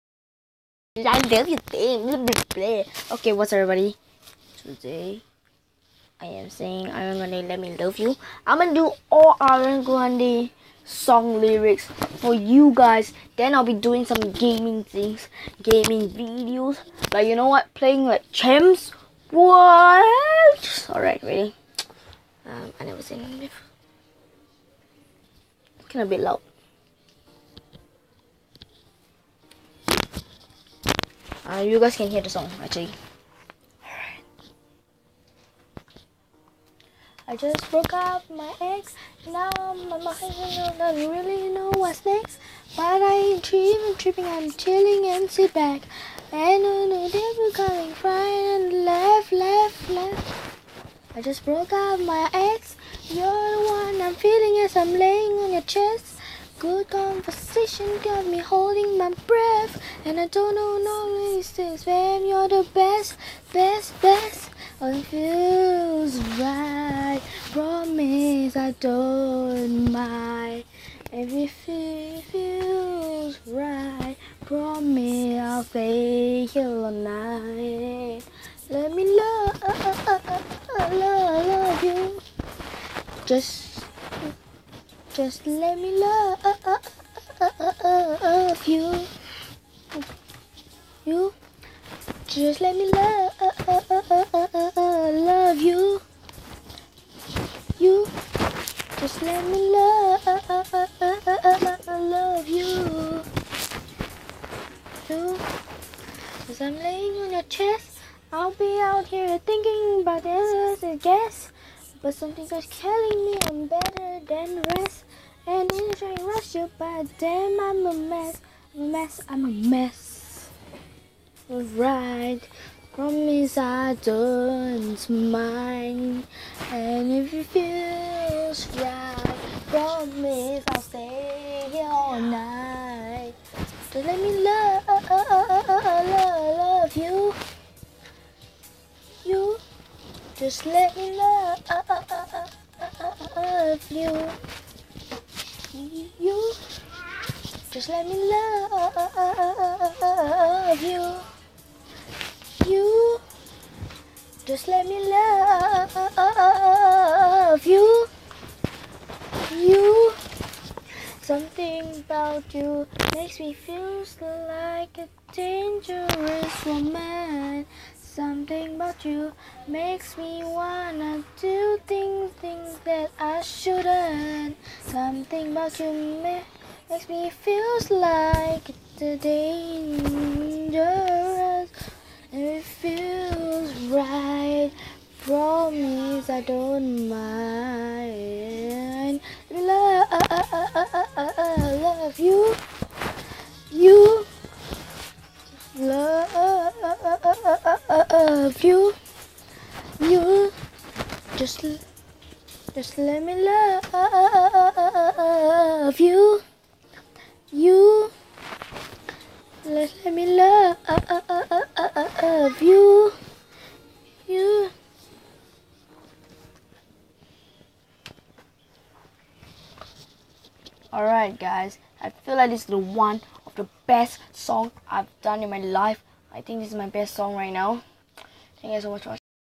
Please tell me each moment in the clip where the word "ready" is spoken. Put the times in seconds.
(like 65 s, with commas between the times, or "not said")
21 s.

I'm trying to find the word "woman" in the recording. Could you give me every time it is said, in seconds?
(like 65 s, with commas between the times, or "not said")
166 s.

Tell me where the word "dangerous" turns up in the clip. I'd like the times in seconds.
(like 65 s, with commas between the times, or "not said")
165 s, 179 s.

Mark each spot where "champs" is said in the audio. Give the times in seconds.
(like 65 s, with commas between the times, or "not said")
18 s.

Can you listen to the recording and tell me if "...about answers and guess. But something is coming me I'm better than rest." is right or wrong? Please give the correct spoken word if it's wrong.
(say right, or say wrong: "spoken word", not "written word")
wrong: "telling", not "coming".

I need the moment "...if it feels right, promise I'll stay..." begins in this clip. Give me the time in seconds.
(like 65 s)
127 s.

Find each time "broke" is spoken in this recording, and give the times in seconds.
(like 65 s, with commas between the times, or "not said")
37 s, 51 s.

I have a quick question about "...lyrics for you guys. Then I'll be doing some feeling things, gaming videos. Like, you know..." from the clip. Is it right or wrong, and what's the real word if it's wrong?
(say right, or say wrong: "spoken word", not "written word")
wrong: "gaming", not "feeling".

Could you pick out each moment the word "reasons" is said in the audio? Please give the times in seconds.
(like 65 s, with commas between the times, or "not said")
61 s.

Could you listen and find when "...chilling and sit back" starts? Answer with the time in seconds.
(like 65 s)
44 s.